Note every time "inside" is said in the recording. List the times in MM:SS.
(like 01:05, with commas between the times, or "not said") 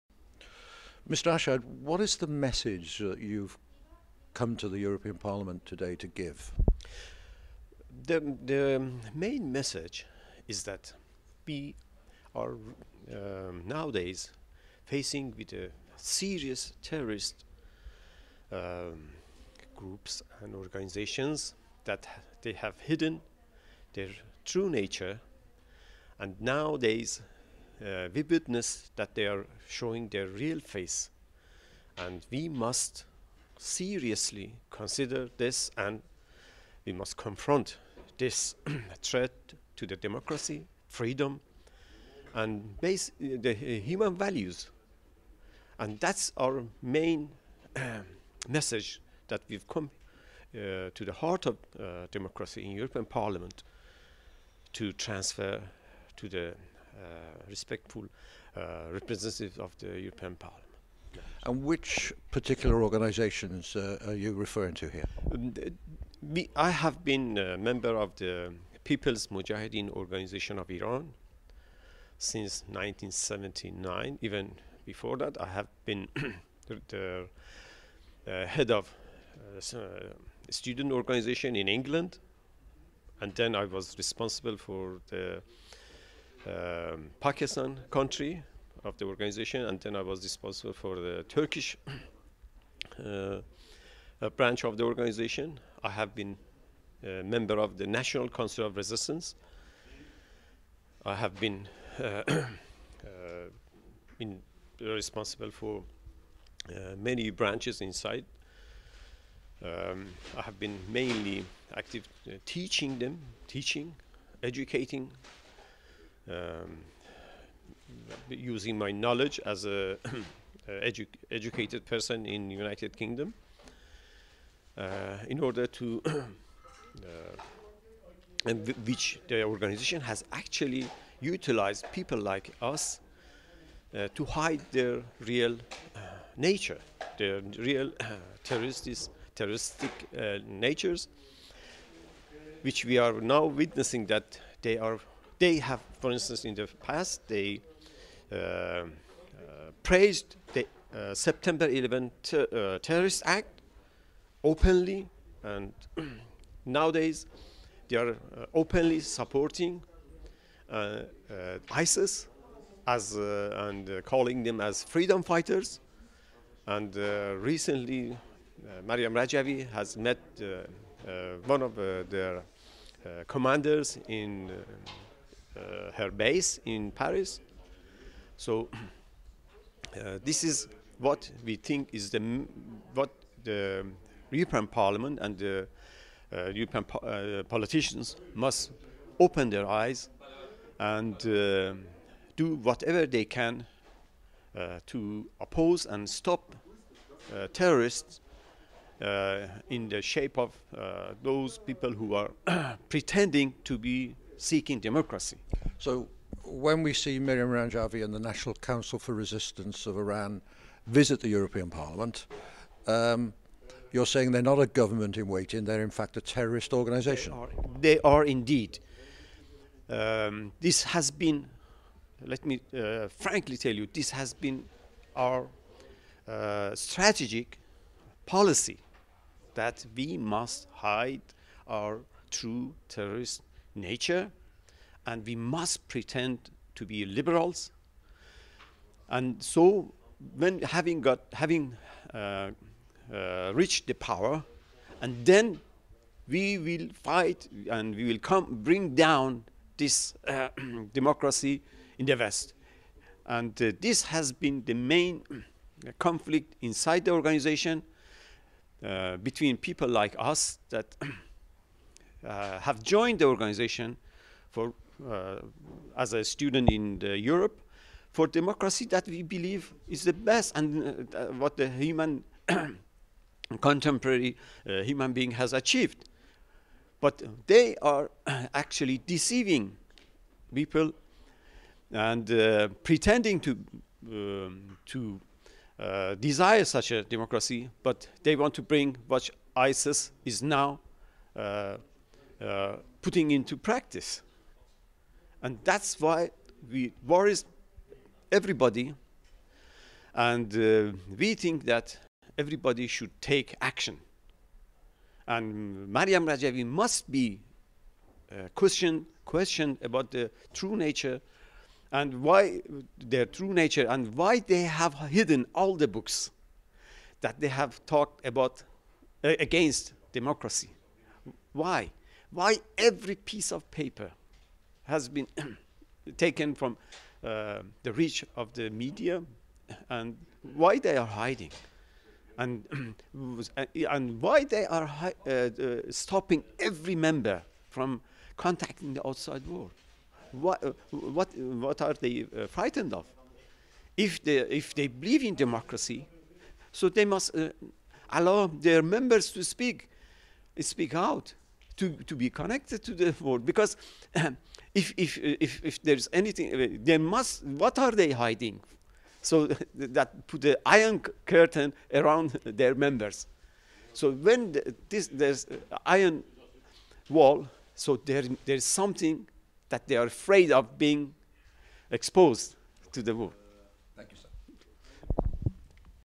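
01:47, 04:16.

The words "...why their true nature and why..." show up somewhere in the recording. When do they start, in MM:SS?
05:12.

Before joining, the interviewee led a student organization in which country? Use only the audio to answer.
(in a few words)
England.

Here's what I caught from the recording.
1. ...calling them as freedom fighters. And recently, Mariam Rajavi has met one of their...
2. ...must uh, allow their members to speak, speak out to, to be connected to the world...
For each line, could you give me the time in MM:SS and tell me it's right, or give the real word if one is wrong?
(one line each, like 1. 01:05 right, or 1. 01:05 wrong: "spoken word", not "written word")
1. 02:44 right
2. 05:47 right.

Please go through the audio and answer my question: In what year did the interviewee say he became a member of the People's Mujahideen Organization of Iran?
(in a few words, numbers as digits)
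1979.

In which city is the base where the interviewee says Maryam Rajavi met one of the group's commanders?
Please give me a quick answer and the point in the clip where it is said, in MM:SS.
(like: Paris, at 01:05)
Paris, at 02:56.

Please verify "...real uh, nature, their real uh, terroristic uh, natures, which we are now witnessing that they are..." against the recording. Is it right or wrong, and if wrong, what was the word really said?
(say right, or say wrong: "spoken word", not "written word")
right.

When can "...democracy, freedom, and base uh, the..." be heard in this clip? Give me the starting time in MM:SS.
00:39.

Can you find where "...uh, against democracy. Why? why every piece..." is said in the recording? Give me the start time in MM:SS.
05:19.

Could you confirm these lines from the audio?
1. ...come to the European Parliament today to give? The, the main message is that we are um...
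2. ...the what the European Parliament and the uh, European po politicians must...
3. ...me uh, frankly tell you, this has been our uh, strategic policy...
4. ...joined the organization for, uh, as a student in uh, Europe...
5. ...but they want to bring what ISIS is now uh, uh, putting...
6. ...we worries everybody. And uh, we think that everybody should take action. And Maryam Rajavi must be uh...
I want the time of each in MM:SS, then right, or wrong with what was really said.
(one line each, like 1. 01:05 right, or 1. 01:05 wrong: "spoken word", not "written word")
1. 00:04 right
2. 03:02 right
3. 03:42 right
4. 04:22 right
5. 04:47 right
6. 04:56 right.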